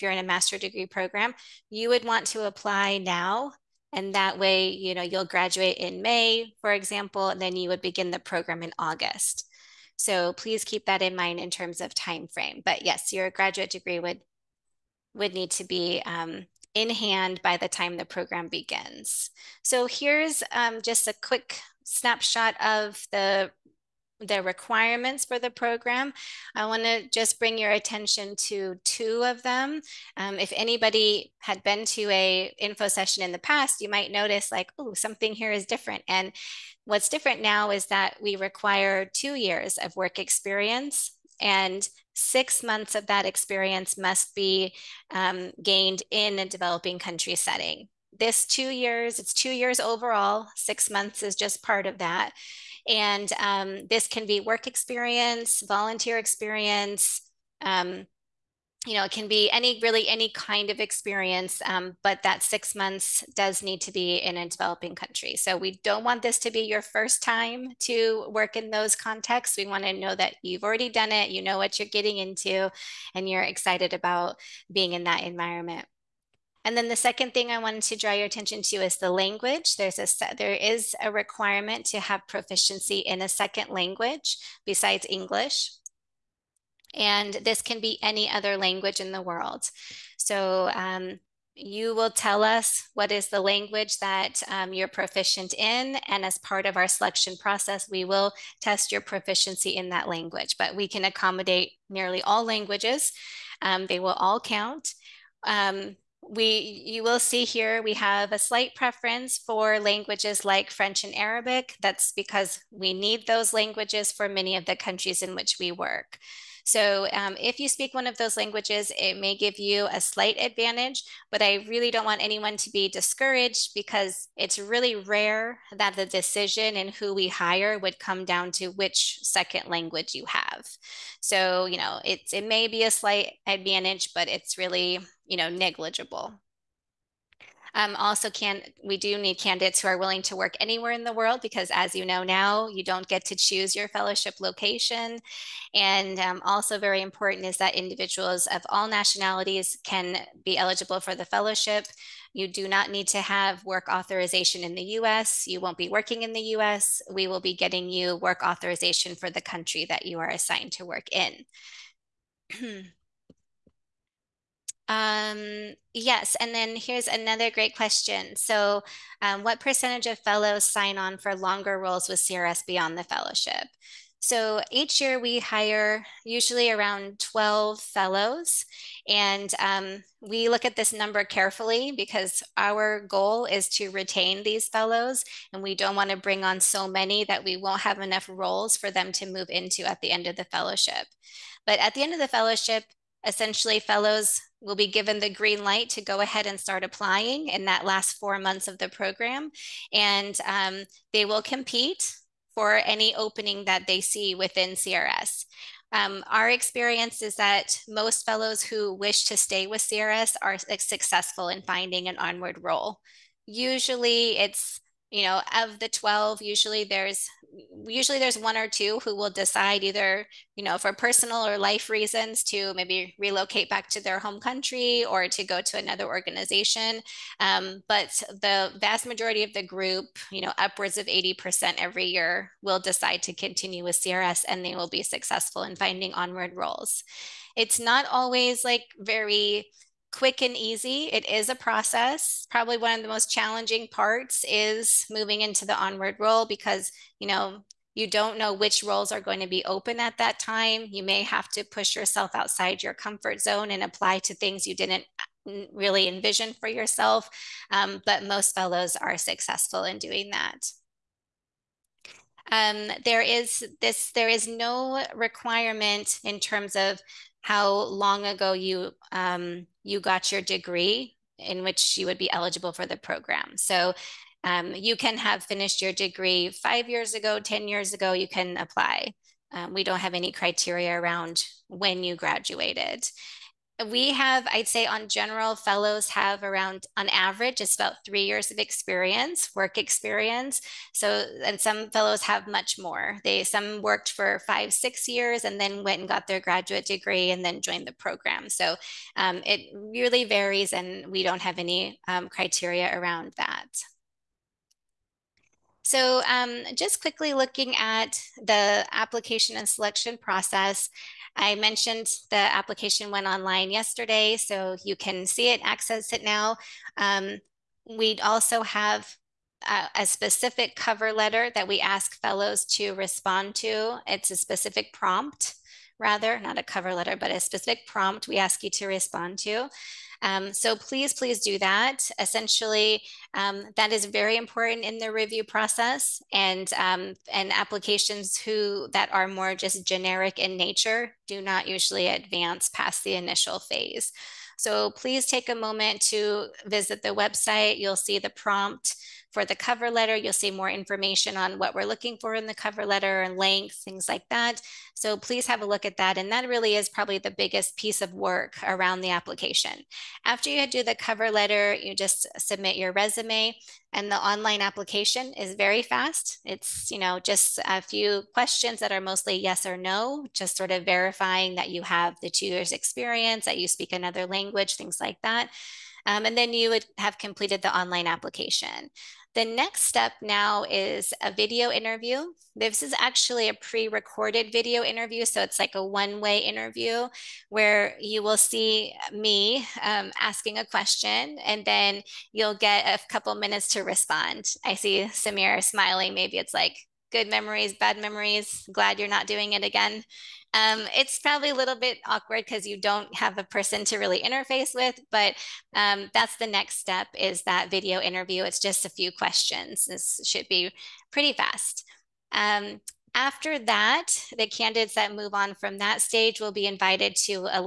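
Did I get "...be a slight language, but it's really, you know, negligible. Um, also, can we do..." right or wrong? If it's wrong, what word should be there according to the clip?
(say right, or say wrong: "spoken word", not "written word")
wrong: "advantage", not "language".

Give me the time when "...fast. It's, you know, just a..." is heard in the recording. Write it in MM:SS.
06:05.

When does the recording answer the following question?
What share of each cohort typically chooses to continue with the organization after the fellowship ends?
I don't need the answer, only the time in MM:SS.
03:51.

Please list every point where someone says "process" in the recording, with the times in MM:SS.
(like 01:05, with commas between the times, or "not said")
01:37, 04:01, 05:10, 05:35.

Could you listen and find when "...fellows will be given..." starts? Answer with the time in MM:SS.
03:13.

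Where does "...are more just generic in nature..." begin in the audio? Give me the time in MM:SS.
05:39.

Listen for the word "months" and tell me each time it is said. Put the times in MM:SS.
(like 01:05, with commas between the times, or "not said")
00:42, 00:50, 01:02, 03:18.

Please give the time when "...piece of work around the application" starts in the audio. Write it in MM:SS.
05:57.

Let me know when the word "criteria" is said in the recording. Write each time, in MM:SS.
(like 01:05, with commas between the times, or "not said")
04:40, 05:02.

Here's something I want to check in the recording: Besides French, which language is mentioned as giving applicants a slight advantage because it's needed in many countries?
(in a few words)
Arabic.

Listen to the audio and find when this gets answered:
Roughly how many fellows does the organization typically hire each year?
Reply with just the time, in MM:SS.
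02:57.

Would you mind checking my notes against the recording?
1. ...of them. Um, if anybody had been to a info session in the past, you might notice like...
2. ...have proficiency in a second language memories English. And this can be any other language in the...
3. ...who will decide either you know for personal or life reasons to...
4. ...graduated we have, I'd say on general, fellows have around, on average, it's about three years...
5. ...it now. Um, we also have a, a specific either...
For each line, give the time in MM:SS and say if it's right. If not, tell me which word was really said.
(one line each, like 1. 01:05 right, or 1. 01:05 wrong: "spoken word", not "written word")
1. 00:29 right
2. 01:21 wrong: "besides", not "memories"
3. 03:39 right
4. 04:42 right
5. 05:16 wrong: "cover", not "either".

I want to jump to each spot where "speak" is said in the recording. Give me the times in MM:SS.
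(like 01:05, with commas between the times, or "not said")
01:57, 06:13.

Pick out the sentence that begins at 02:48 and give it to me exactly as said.
So, um, what percentage of fellows sign on for longer roles with CRS beyond the fellowship?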